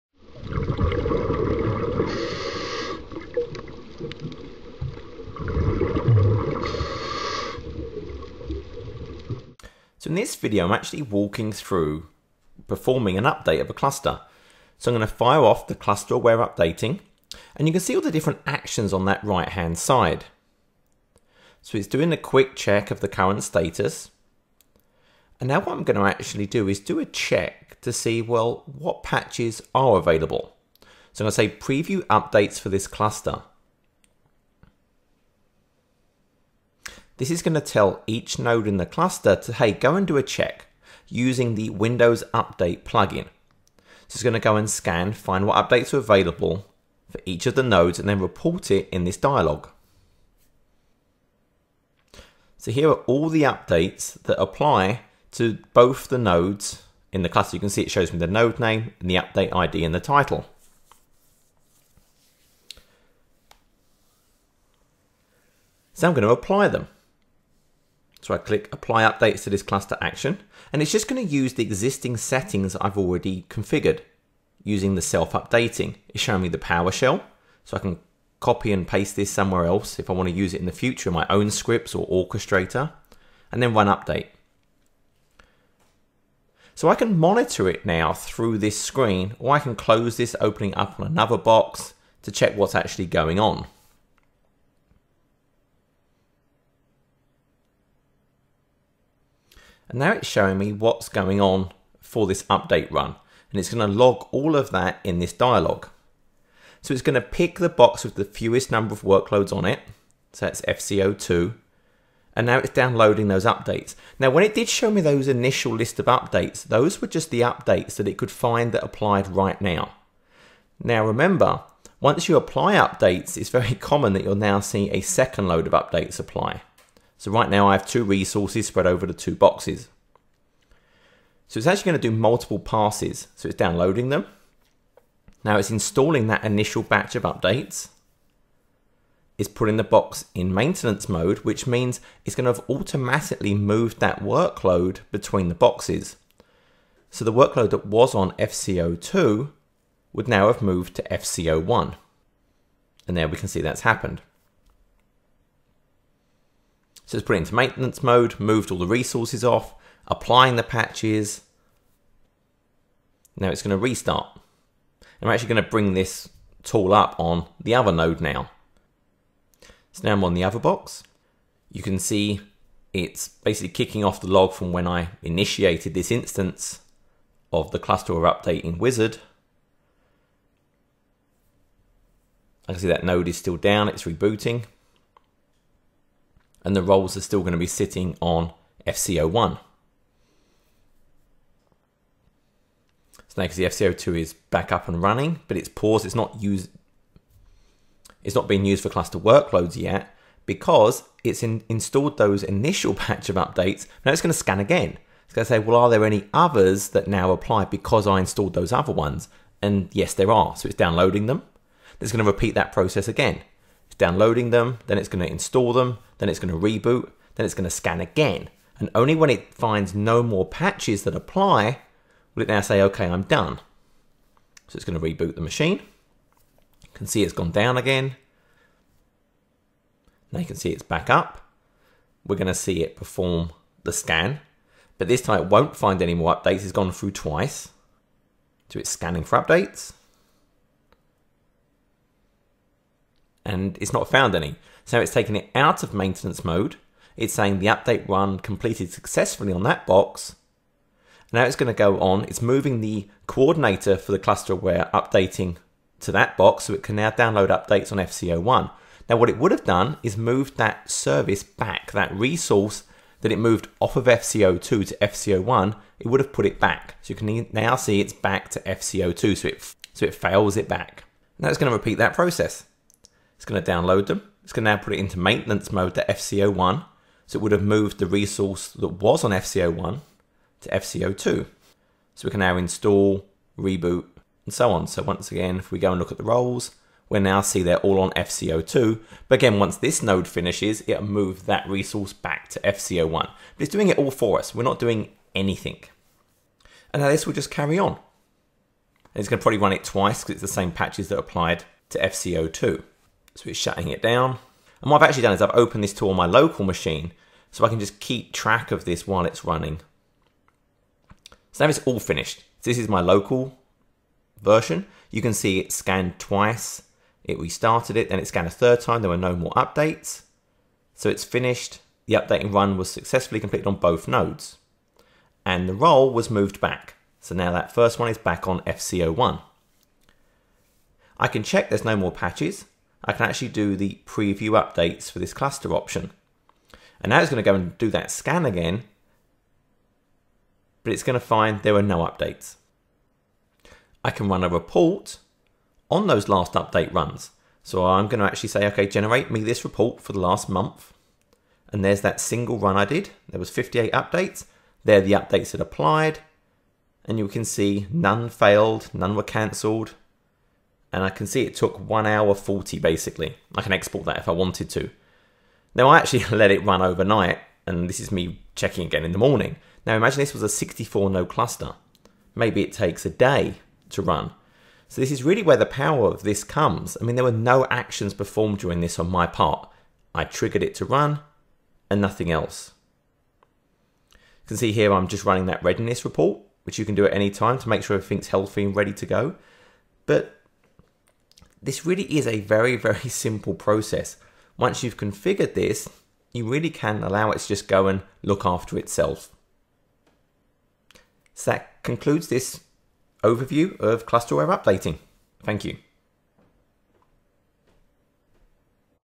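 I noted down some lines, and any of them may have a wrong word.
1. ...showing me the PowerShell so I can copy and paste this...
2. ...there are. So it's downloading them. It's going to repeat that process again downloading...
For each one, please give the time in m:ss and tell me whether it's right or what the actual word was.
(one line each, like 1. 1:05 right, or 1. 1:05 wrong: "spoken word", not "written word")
1. 1:16 right
2. 3:30 right.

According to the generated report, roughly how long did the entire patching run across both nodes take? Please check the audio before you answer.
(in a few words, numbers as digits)
1 hour 40.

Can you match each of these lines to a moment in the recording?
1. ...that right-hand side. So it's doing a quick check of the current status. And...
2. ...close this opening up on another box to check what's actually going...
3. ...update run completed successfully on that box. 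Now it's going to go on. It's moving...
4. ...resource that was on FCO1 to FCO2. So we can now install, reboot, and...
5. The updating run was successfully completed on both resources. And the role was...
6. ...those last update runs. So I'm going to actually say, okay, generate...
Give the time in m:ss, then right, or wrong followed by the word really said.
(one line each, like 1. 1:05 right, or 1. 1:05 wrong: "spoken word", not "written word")
1. 0:19 right
2. 1:29 right
3. 4:07 right
4. 4:38 right
5. 5:22 wrong: "nodes", not "resources"
6. 5:46 right.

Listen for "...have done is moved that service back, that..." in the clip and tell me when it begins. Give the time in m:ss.
4:19.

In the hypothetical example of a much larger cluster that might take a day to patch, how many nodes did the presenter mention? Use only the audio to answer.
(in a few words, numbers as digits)
64.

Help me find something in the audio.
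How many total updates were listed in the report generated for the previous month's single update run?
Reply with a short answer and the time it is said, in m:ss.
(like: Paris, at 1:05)
58, at 5:53.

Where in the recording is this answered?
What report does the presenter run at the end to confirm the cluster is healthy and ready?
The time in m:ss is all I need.
6:25.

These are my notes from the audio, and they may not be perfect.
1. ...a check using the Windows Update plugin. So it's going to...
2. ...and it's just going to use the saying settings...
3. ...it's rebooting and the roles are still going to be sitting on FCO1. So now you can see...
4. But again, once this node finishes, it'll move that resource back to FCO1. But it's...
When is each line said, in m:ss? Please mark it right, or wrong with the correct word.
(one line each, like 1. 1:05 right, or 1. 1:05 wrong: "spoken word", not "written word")
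1. 0:40 right
2. 1:10 wrong: "existing", not "saying"
3. 3:03 right
4. 4:49 right.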